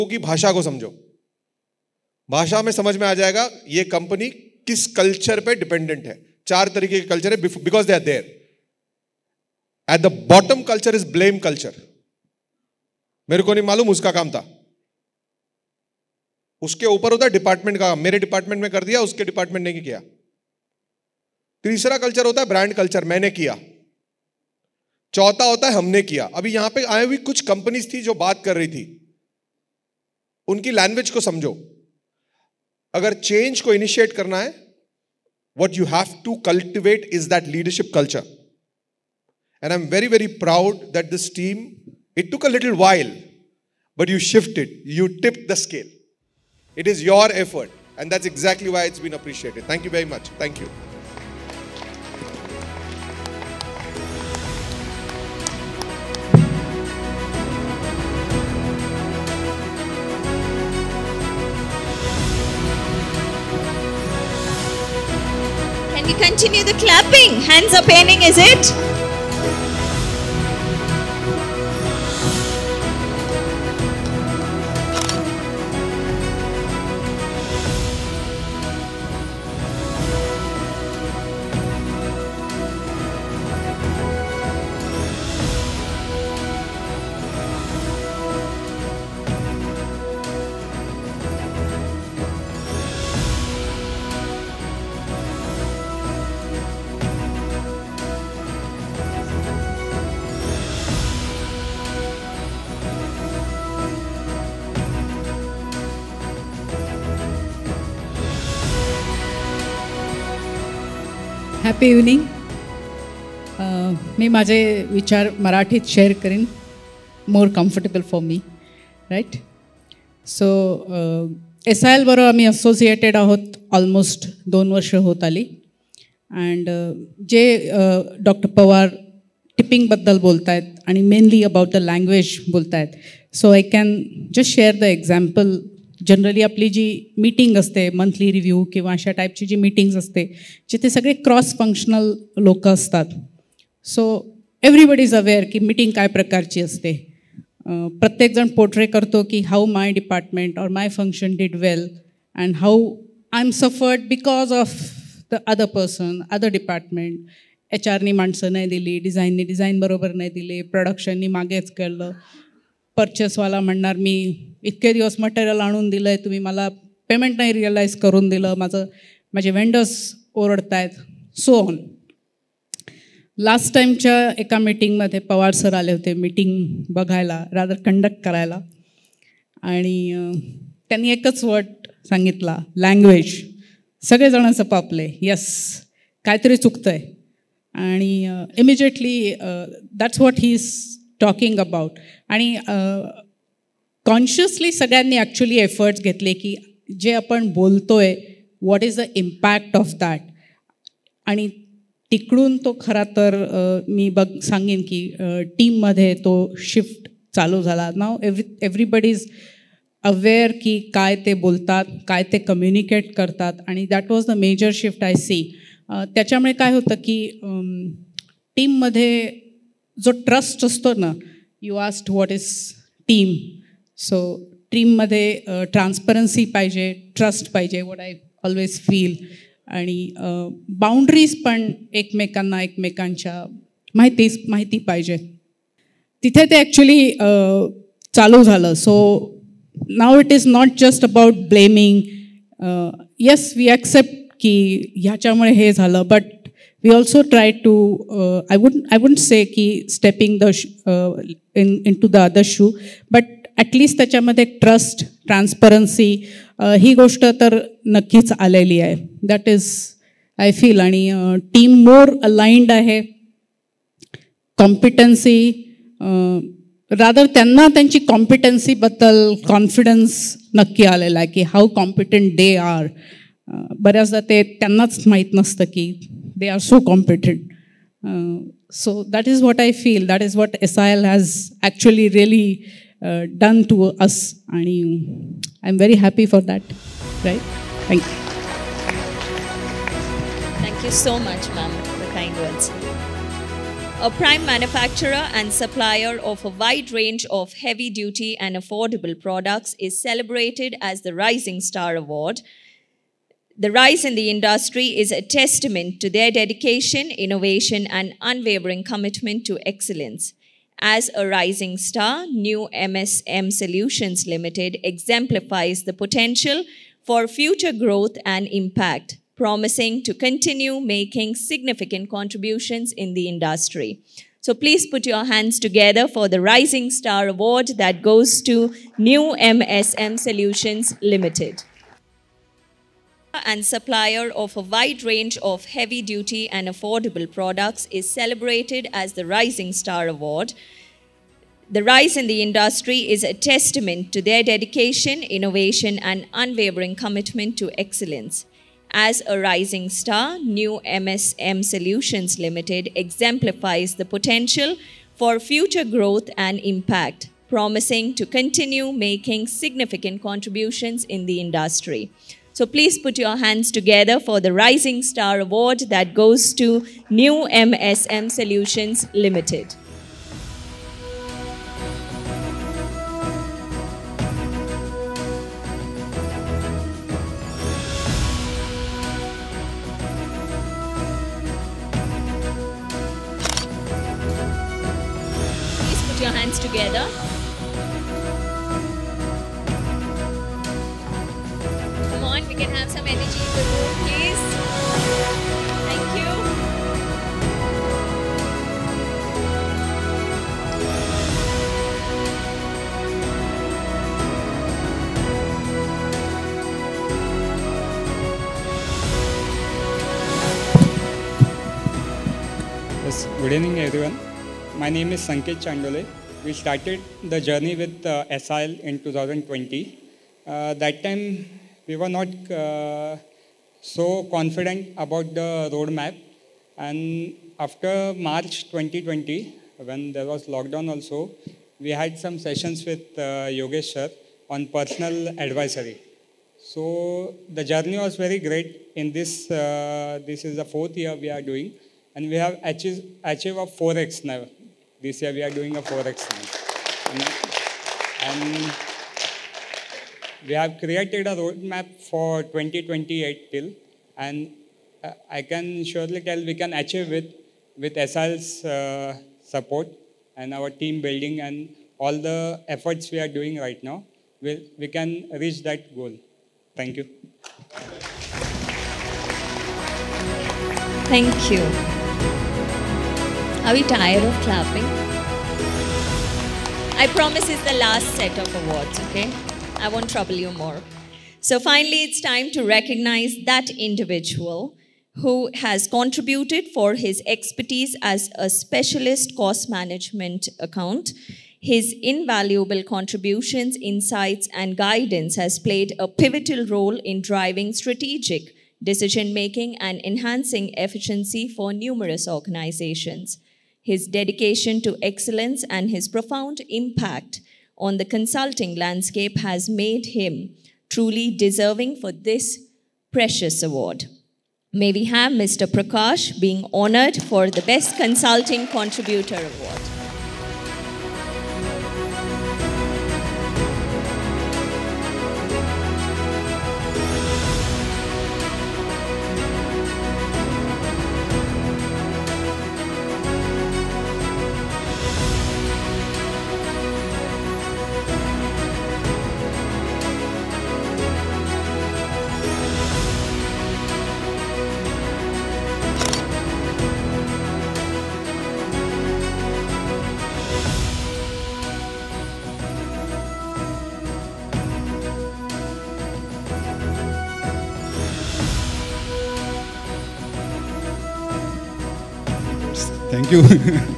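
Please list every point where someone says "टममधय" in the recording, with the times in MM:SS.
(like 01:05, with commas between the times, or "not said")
03:25, 03:38, 03:44.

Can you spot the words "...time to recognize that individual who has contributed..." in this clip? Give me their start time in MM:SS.
08:02.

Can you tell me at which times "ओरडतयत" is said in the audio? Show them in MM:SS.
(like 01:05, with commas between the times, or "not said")
02:50.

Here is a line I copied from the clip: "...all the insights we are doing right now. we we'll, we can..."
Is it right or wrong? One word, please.
wrong.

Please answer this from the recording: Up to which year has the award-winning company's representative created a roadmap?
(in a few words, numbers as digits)
2028.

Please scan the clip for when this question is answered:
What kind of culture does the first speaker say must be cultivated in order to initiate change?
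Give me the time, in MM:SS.
00:37.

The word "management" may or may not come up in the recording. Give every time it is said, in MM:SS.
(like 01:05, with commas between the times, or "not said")
08:09.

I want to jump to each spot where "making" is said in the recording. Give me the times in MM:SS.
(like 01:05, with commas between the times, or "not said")
05:20, 05:58, 08:19.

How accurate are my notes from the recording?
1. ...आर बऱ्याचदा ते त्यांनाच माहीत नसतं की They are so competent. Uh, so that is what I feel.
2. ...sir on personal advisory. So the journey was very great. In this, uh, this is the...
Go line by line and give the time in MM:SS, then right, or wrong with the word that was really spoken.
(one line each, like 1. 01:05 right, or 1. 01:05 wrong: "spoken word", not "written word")
1. 04:32 right
2. 07:13 right.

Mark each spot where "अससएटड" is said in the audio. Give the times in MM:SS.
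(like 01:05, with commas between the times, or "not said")
02:02.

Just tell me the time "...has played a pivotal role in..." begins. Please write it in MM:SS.
08:15.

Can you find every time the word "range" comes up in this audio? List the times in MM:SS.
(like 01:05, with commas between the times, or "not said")
04:56, 05:35.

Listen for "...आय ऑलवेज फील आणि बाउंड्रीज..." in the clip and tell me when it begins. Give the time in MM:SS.
03:47.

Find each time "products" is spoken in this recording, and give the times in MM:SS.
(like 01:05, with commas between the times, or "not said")
04:59, 05:37.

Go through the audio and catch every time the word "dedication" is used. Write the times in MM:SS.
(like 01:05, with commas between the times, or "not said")
05:06, 05:44, 08:24.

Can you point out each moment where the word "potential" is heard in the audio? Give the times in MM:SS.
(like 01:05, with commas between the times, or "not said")
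05:15, 05:54.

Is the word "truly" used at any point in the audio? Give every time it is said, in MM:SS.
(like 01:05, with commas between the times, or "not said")
08:30.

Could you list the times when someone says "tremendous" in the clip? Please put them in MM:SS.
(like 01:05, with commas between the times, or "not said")
not said.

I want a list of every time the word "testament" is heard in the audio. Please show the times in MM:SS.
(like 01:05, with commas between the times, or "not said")
05:05, 05:43.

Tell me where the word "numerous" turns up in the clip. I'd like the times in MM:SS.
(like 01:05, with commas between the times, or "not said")
08:21.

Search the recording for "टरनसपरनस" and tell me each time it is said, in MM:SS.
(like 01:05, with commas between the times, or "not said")
03:45, 04:15.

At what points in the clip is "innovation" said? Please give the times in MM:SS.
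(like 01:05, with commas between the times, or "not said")
05:07, 05:45.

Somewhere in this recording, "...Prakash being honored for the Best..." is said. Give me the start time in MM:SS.
08:35.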